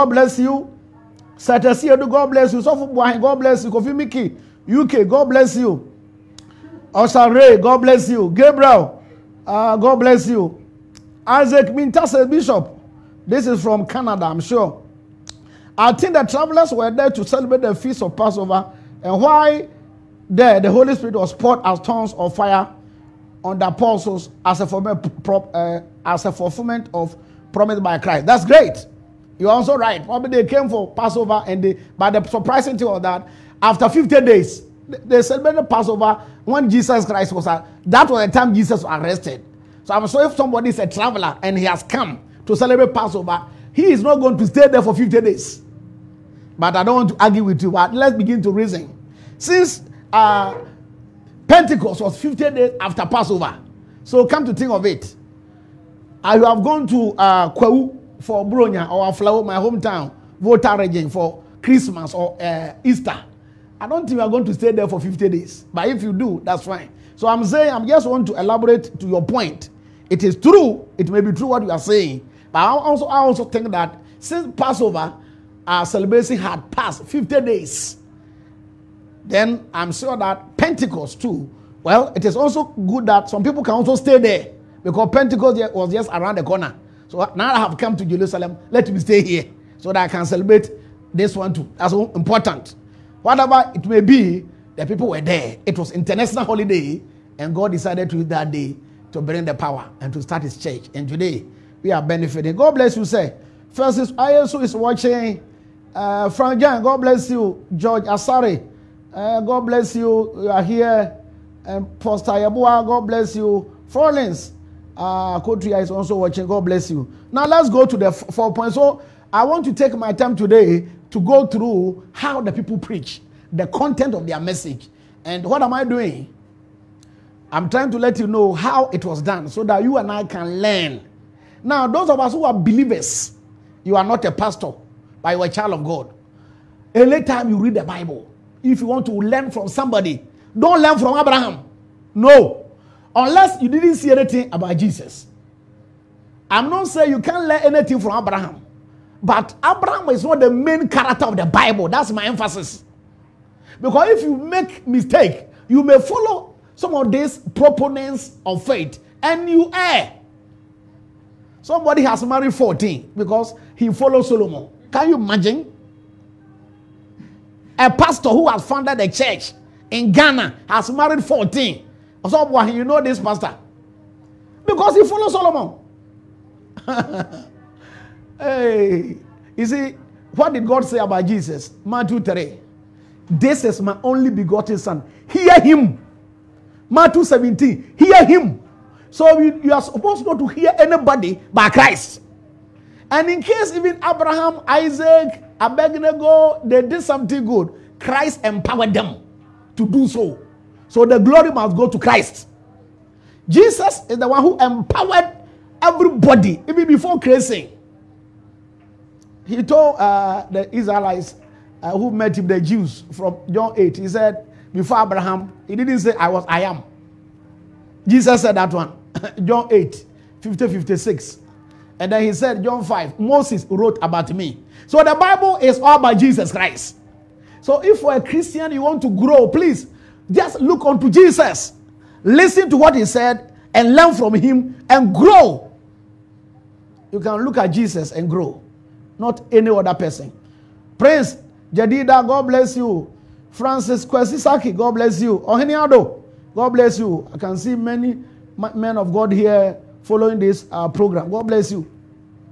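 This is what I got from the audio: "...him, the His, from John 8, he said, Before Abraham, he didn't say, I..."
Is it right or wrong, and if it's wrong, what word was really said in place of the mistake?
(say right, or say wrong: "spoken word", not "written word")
wrong: "Jews", not "His".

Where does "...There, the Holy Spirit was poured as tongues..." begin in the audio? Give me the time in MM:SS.
00:20.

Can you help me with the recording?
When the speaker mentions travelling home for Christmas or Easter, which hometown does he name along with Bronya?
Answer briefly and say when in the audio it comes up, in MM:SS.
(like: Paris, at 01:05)
Aflao, at 00:59.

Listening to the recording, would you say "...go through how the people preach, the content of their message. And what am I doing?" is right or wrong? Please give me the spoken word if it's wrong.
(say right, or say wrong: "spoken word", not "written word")
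right.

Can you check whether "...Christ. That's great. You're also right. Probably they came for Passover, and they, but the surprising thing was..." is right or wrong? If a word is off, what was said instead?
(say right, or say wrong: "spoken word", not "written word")
right.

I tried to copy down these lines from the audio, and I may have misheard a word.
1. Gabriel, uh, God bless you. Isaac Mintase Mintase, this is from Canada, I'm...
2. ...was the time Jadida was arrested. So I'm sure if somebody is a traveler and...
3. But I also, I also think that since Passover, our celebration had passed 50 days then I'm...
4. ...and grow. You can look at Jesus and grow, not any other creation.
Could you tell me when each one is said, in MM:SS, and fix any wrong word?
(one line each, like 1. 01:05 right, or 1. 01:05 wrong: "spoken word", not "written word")
1. 00:08 wrong: "Bishop", not "Mintase"
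2. 00:38 wrong: "Jesus", not "Jadida"
3. 01:12 right
4. 03:54 wrong: "person", not "creation".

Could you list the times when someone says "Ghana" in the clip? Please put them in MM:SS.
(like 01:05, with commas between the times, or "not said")
02:50.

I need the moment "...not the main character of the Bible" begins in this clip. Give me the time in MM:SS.
02:30.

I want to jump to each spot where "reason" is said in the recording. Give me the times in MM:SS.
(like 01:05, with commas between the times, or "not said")
00:48.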